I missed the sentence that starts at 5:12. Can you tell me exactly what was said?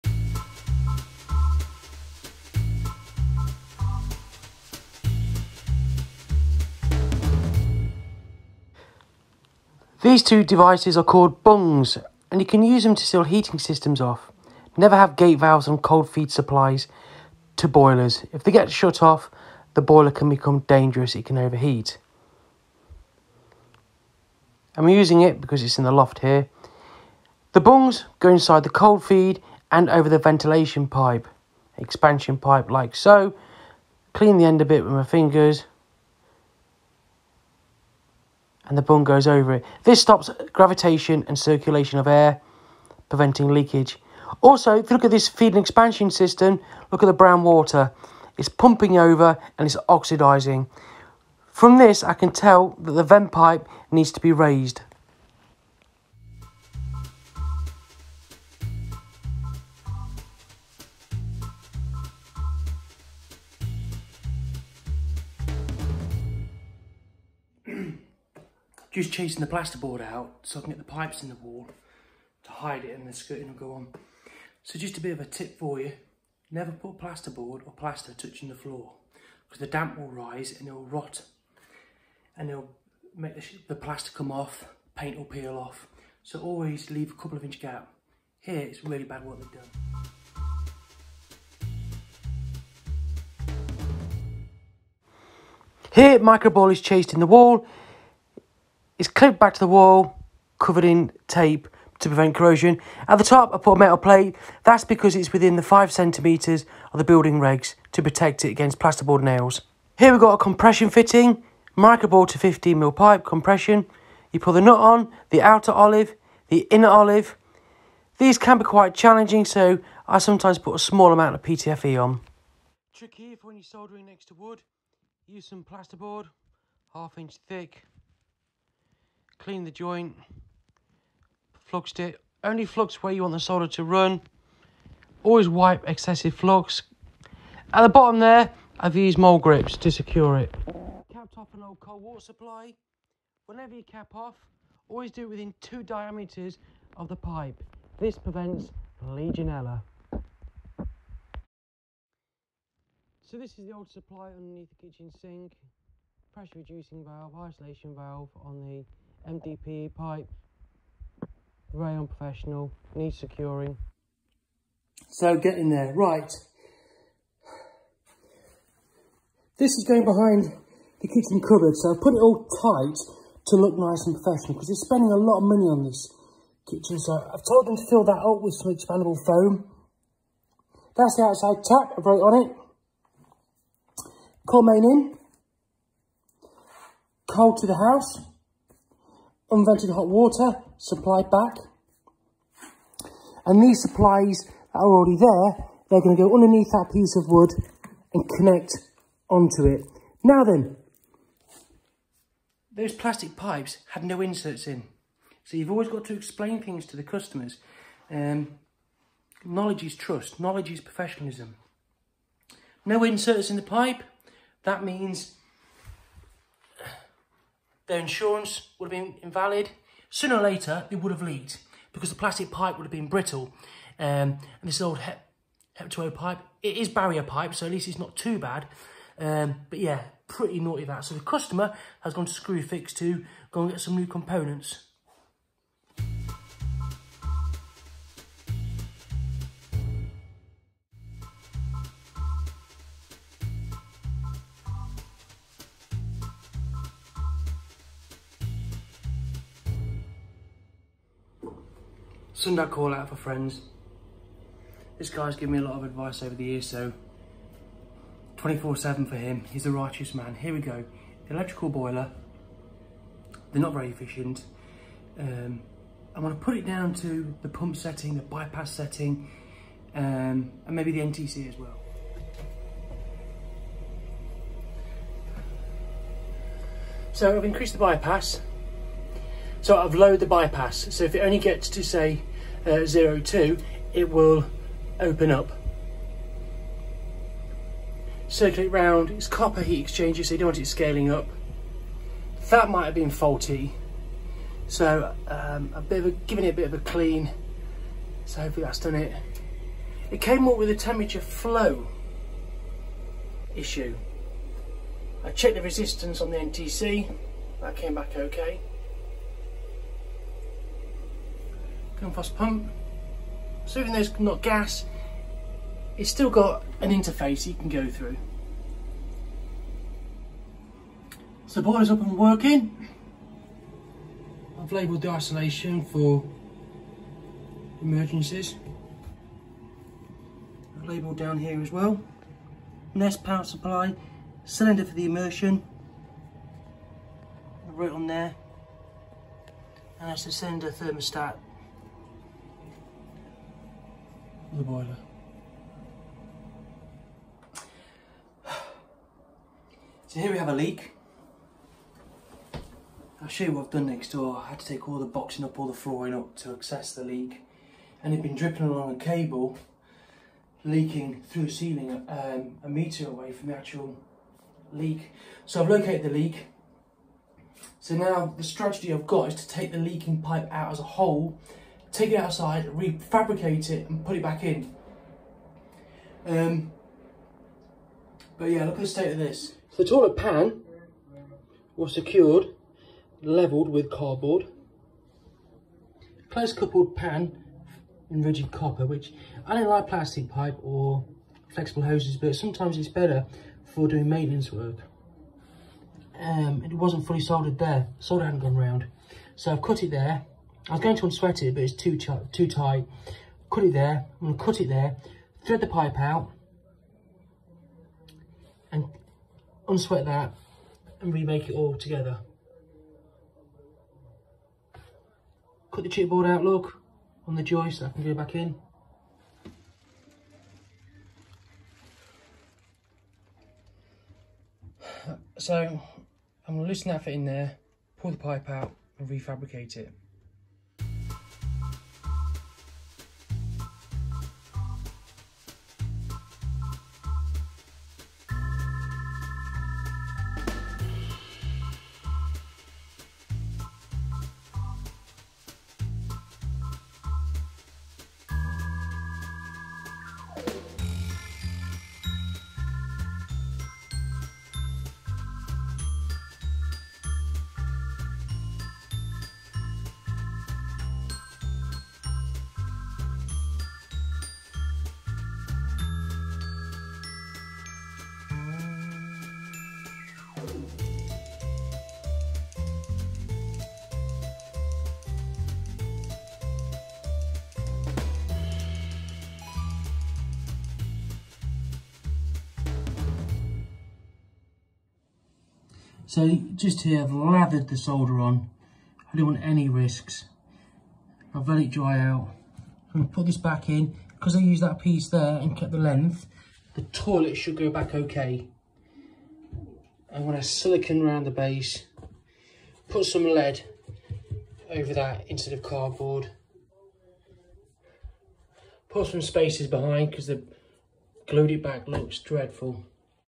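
Film Pump, so even though it's not gas, it's still got an interface you can go through.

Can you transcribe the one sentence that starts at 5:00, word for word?
It came up with a temperature flow issue.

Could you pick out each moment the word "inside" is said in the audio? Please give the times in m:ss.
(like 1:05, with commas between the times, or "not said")
0:28.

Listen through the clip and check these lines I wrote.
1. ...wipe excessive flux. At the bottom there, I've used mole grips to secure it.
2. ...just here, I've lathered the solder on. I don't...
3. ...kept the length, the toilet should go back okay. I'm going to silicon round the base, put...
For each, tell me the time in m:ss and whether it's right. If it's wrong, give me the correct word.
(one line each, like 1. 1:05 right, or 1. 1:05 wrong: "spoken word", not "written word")
1. 2:15 right
2. 8:06 right
3. 8:15 right.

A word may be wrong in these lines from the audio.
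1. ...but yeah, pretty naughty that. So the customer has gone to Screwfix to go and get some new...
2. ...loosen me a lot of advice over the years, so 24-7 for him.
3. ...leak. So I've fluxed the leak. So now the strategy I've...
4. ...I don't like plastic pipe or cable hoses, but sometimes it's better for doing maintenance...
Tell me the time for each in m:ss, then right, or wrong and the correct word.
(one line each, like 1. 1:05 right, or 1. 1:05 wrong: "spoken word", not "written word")
1. 3:49 right
2. 4:15 wrong: "given", not "loosen"
3. 6:04 wrong: "located", not "fluxed"
4. 6:29 wrong: "flexible", not "cable".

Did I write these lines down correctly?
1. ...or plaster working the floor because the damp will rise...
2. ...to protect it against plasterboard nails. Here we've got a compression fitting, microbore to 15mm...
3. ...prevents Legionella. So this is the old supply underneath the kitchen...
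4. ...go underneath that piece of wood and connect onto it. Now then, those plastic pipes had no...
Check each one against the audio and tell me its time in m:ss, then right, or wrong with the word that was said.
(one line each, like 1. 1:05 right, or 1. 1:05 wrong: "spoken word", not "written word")
1. 1:17 wrong: "touching", not "working"
2. 1:47 right
3. 2:28 right
4. 3:16 right.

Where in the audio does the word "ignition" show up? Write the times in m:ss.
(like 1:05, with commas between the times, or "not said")
not said.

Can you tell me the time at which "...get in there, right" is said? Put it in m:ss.
2:45.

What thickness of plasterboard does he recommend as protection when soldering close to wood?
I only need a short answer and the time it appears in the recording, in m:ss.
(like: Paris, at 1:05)
Half inch, at 2:06.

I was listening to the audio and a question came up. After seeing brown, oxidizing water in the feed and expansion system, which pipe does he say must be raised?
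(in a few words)
The vent pipe.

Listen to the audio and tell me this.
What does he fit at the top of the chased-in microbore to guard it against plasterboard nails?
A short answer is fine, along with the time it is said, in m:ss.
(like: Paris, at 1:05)
A metal plate, at 1:43.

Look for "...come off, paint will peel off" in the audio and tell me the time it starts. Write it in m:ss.
1:24.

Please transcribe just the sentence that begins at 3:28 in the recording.
Um, knowledge is trust, knowledge is professionalism.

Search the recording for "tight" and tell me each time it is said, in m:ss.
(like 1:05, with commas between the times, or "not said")
2:52, 6:42.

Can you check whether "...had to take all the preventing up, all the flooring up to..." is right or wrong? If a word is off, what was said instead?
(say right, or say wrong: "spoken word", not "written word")
wrong: "boxing", not "preventing".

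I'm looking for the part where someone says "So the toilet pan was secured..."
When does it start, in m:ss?
6:19.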